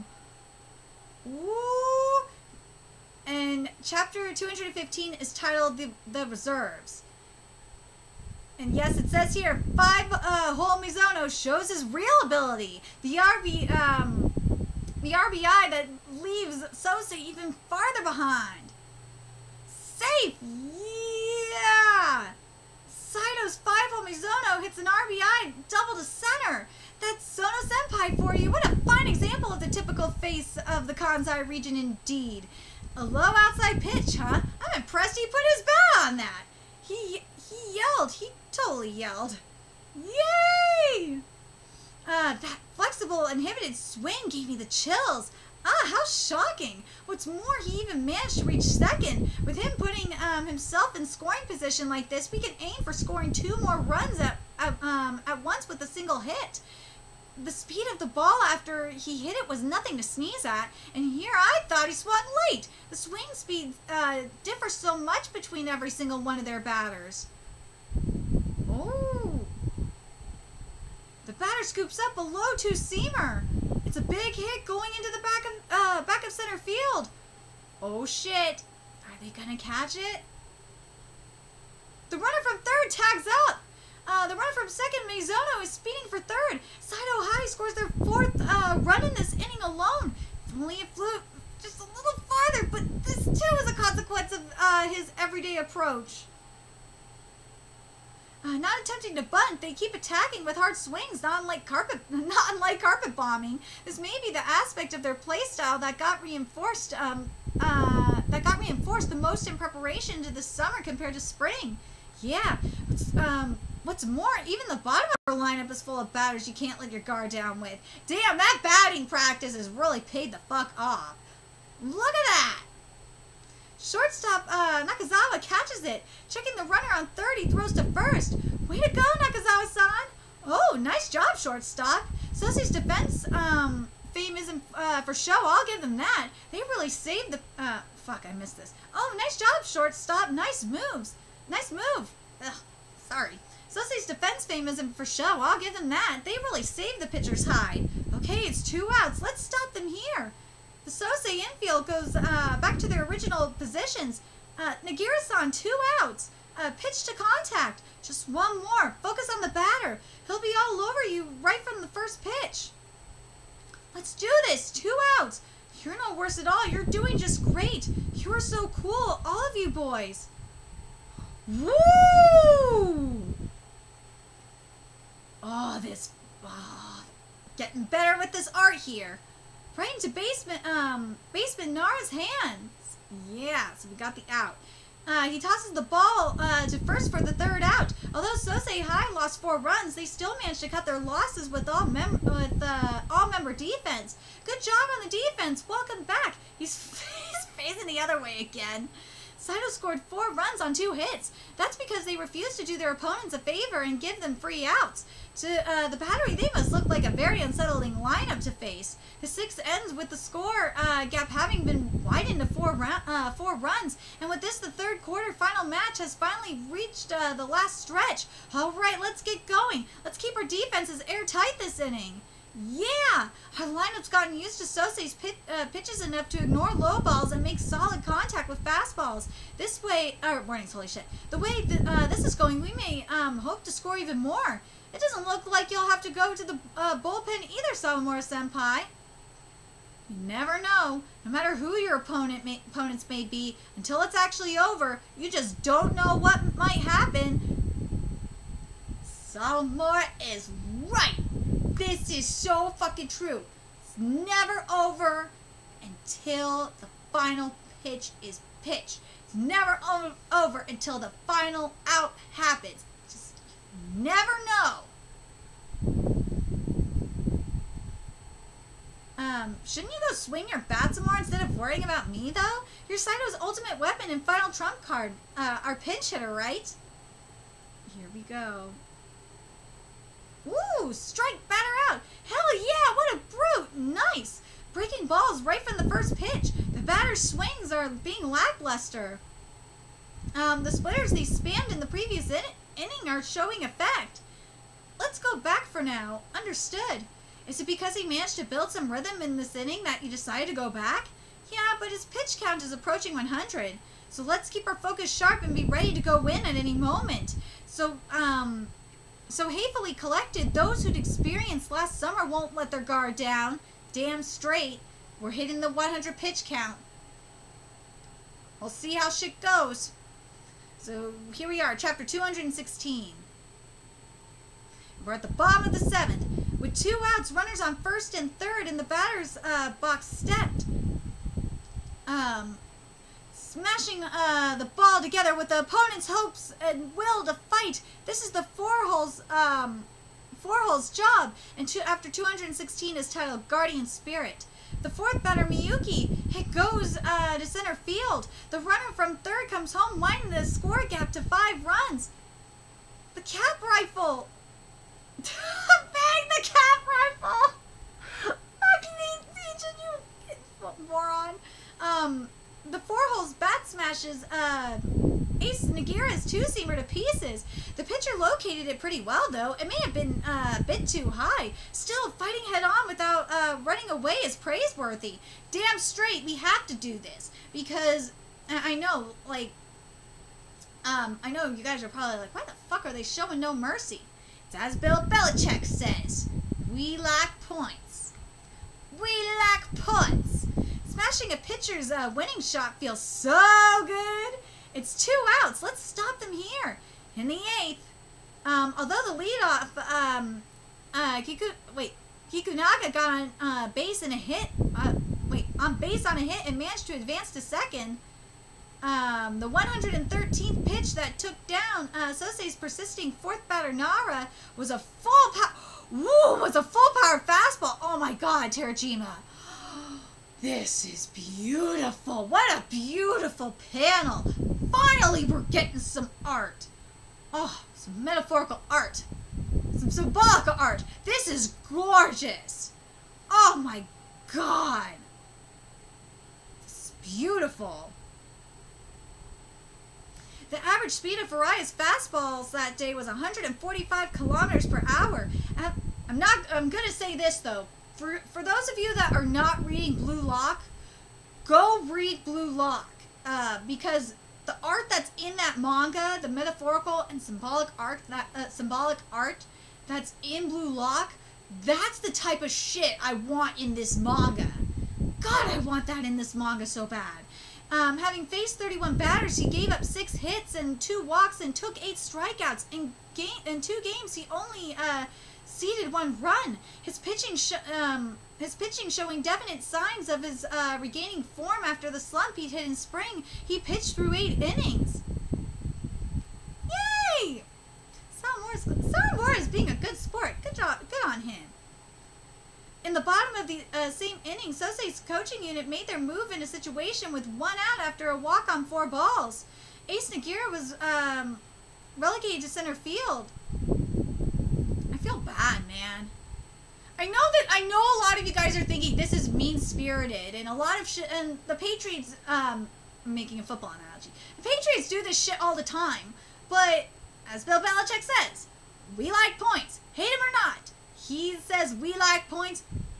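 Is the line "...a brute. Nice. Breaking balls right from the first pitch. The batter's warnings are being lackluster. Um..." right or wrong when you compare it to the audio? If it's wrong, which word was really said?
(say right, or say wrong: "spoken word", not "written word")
wrong: "swings", not "warnings".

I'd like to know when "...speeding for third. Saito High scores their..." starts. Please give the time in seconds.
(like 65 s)
85 s.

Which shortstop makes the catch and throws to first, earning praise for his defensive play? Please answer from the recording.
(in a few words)
Nakazawa.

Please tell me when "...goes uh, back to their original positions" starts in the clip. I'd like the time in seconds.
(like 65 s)
151 s.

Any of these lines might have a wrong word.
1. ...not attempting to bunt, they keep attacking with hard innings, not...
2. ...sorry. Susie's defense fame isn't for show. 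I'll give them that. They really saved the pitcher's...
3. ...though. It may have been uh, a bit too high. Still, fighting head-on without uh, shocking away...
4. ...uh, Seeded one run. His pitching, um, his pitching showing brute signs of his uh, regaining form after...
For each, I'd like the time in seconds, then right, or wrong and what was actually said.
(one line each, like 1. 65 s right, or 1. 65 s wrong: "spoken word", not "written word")
1. 98 s wrong: "swings", not "innings"
2. 143 s right
3. 369 s wrong: "running", not "shocking"
4. 474 s wrong: "definite", not "brute".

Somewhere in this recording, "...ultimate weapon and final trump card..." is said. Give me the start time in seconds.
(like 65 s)
273 s.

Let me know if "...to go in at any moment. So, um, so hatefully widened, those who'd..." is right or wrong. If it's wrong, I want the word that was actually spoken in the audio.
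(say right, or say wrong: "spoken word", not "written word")
wrong: "collected", not "widened".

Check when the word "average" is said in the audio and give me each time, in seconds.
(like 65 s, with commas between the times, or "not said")
440 s.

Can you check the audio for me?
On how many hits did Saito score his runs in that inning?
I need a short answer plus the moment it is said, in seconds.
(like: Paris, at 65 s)
2, at 200 s.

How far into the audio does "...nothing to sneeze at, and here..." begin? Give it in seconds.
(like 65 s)
59 s.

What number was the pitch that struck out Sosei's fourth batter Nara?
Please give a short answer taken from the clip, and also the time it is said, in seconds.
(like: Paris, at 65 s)
113th, at 409 s.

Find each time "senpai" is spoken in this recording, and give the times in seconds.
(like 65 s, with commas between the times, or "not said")
27 s, 238 s.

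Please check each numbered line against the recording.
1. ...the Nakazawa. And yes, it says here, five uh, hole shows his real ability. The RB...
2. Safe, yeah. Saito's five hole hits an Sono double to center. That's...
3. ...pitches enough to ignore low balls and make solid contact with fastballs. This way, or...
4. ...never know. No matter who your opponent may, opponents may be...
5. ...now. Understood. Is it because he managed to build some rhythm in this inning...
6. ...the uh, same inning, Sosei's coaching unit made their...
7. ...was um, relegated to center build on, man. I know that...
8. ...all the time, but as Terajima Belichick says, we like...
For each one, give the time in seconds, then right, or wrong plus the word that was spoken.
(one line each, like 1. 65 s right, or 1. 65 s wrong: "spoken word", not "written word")
1. 6 s wrong: "Reserves", not "Nakazawa"
2. 19 s wrong: "RBI", not "Sono"
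3. 225 s right
4. 240 s right
5. 295 s right
6. 493 s right
7. 500 s wrong: "field", not "build"
8. 515 s wrong: "Bill", not "Terajima".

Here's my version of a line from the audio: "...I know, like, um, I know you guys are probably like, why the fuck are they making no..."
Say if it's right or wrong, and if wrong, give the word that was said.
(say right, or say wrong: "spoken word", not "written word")
wrong: "showing", not "making".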